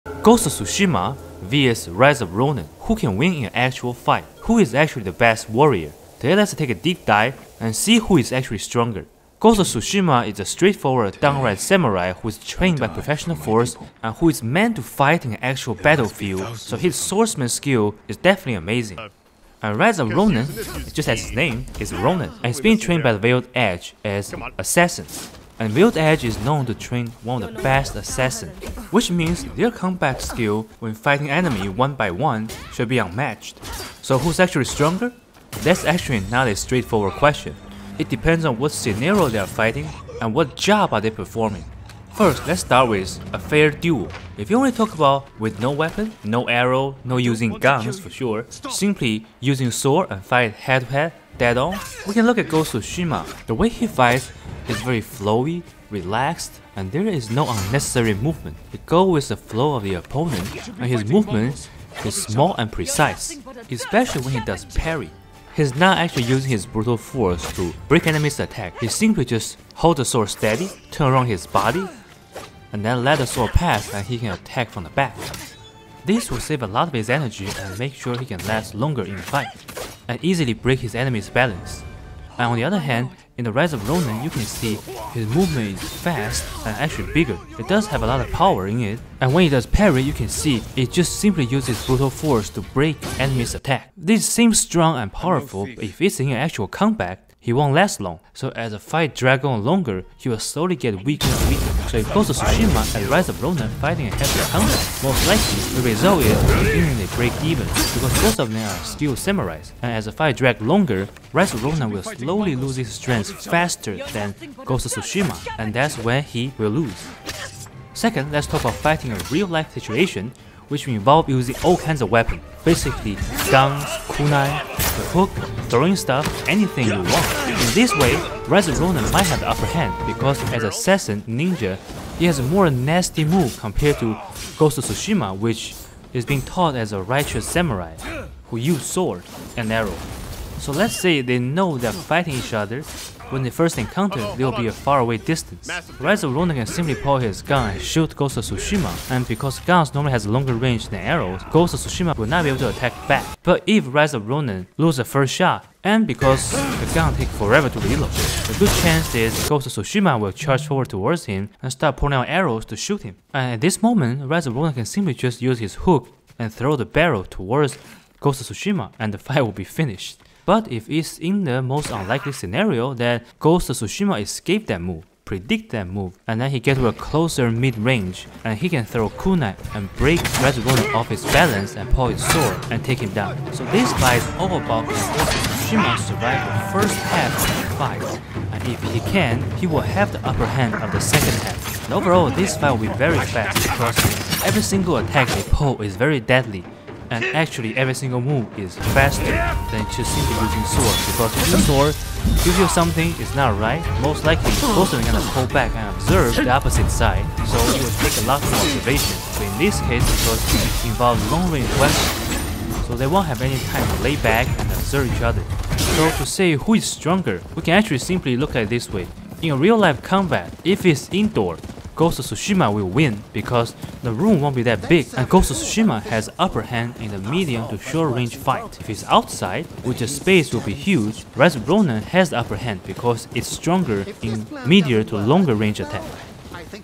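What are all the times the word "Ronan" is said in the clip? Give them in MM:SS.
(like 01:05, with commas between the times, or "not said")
02:08.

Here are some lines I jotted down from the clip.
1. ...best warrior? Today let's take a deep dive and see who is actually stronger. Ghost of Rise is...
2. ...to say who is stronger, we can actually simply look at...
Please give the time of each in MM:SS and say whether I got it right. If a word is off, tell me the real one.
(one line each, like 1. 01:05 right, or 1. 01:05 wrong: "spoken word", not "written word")
1. 00:05 wrong: "Tsushima", not "Rise"
2. 03:36 right.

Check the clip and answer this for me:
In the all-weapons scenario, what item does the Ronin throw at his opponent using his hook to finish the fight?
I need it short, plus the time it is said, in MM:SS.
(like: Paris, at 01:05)
the barrel, at 02:46.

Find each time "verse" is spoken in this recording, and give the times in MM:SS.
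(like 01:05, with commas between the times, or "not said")
not said.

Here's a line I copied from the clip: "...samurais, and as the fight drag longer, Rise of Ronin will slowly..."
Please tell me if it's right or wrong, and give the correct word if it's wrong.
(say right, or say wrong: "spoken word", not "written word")
right.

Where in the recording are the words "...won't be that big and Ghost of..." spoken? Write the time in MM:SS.
03:44.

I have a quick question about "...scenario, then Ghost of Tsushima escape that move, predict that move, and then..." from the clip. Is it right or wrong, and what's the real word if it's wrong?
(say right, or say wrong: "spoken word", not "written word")
right.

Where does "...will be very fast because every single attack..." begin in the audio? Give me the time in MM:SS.
03:12.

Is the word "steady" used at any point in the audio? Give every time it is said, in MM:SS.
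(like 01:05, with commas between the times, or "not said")
01:10.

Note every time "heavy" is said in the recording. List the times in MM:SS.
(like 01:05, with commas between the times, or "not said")
01:44.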